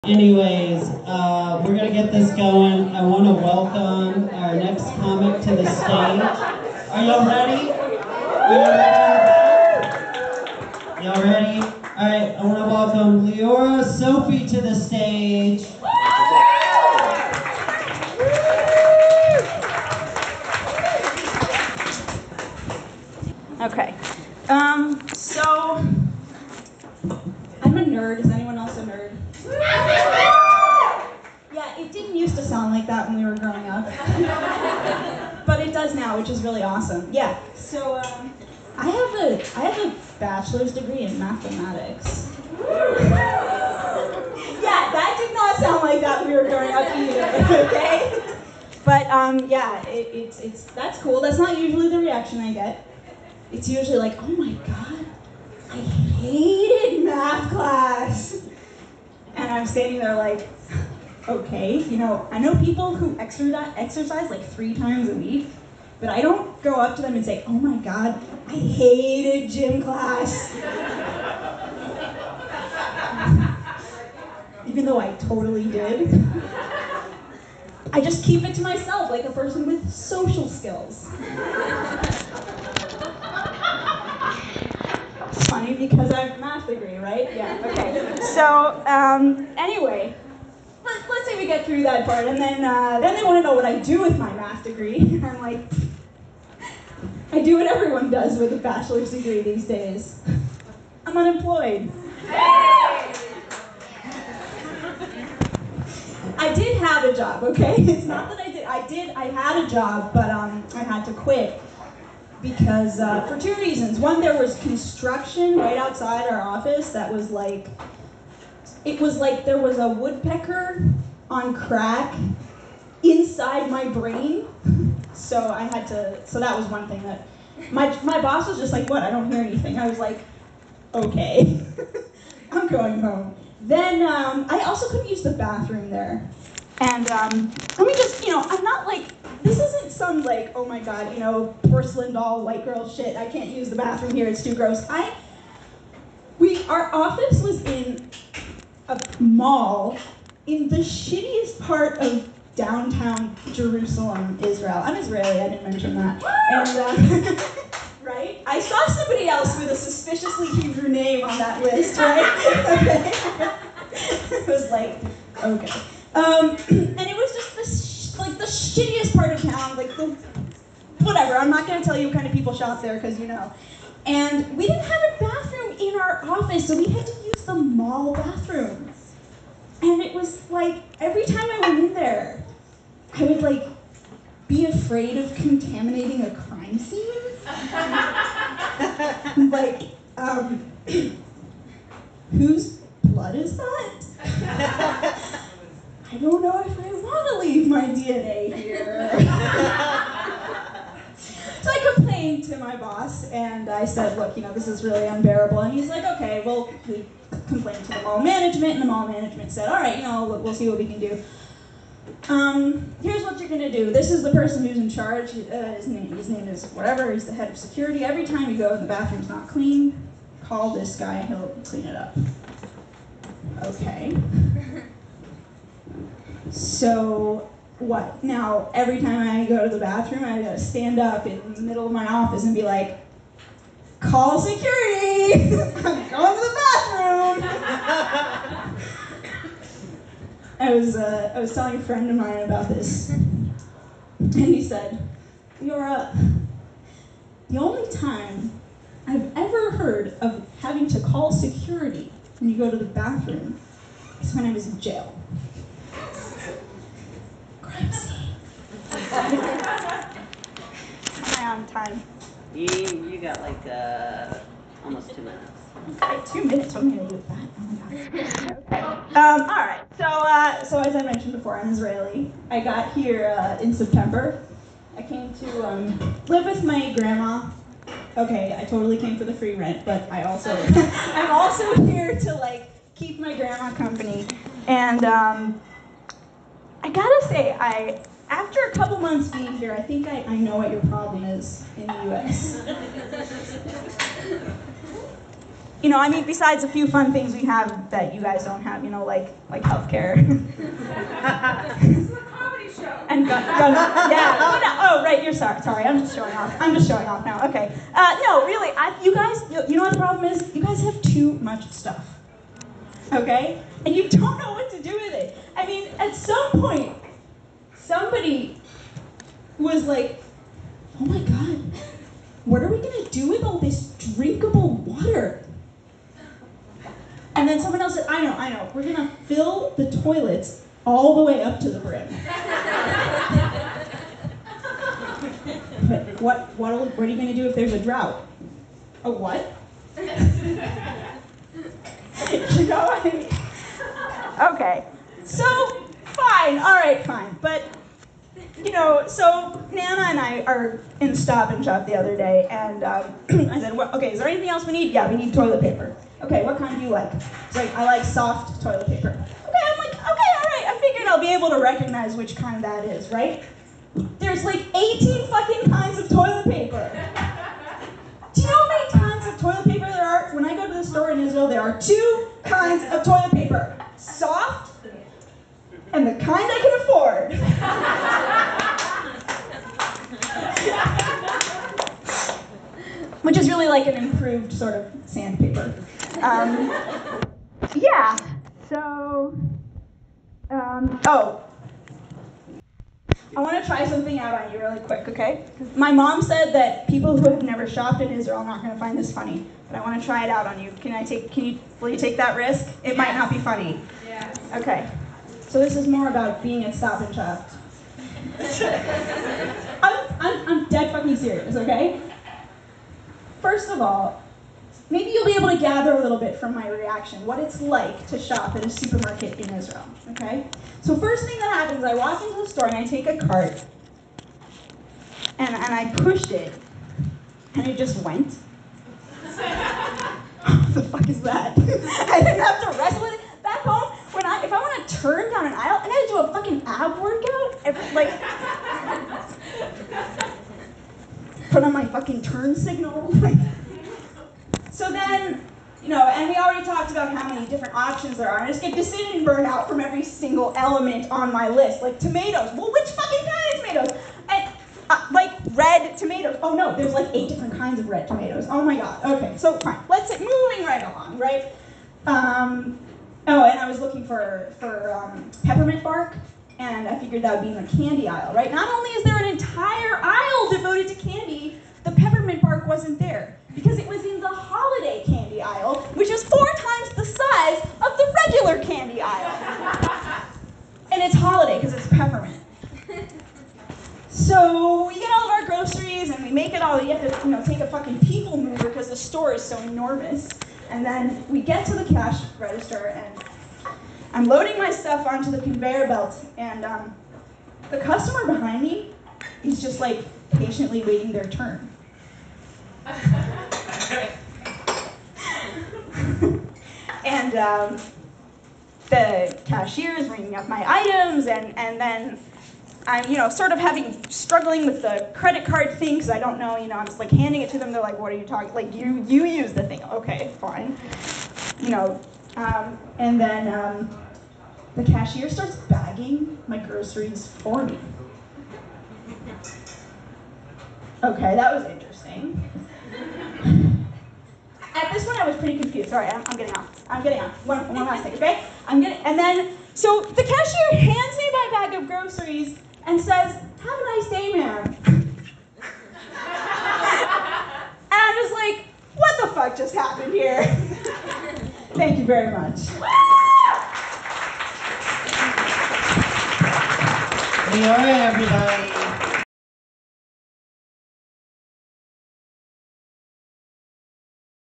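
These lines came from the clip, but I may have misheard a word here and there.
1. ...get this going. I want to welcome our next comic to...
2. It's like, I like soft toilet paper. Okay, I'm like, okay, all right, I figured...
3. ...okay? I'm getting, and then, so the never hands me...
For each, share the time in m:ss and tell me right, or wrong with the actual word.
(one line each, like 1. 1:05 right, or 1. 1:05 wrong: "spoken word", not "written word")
1. 0:01 right
2. 5:57 right
3. 8:58 wrong: "cashier", not "never".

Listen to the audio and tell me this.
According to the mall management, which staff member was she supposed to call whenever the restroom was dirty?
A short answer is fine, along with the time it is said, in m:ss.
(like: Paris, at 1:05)
Head of security, at 3:37.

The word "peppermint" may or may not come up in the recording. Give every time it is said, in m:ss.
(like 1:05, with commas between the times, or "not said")
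7:45, 7:51, 8:01.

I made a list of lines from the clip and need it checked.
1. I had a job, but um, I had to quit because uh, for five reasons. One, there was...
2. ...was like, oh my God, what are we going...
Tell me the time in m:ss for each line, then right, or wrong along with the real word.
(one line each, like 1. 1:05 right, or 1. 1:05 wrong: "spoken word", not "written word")
1. 1:49 wrong: "two", not "five"
2. 5:19 right.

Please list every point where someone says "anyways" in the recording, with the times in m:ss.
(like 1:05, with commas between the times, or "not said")
0:00, 1:29.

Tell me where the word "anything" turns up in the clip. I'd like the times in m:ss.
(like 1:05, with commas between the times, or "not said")
2:09, 5:54.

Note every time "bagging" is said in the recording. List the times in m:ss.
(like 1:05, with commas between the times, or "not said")
8:45.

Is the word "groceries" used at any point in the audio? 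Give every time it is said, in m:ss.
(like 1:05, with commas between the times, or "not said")
8:05, 8:46, 9:01.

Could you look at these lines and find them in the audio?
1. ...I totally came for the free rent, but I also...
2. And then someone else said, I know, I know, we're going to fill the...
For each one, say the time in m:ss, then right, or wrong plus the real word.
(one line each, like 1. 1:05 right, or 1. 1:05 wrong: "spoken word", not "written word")
1. 4:38 right
2. 5:27 right.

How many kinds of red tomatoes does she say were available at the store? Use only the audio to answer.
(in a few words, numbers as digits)
8.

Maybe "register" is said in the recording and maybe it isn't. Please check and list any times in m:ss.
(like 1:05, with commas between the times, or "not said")
8:12.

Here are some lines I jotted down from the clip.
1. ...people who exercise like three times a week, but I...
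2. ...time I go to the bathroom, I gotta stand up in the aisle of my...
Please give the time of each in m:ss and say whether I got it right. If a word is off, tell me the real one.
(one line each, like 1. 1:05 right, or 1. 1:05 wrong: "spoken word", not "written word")
1. 1:02 right
2. 3:48 wrong: "middle", not "aisle".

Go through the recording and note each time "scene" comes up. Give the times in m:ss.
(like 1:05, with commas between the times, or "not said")
3:06, 4:17.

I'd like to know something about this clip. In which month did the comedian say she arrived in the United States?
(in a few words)
September.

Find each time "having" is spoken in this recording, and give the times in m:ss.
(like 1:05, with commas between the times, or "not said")
4:10, 8:33.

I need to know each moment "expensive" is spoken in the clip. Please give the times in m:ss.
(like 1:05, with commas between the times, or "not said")
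not said.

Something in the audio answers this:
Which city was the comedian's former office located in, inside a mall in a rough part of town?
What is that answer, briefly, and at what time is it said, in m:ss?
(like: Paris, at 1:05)
Jerusalem, at 2:33.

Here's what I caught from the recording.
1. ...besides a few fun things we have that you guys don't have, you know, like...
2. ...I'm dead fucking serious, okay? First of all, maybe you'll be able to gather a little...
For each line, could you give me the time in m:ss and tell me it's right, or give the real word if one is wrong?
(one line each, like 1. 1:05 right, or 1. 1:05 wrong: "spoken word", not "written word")
1. 4:56 right
2. 6:50 right.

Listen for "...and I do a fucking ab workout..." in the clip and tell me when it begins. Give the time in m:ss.
7:15.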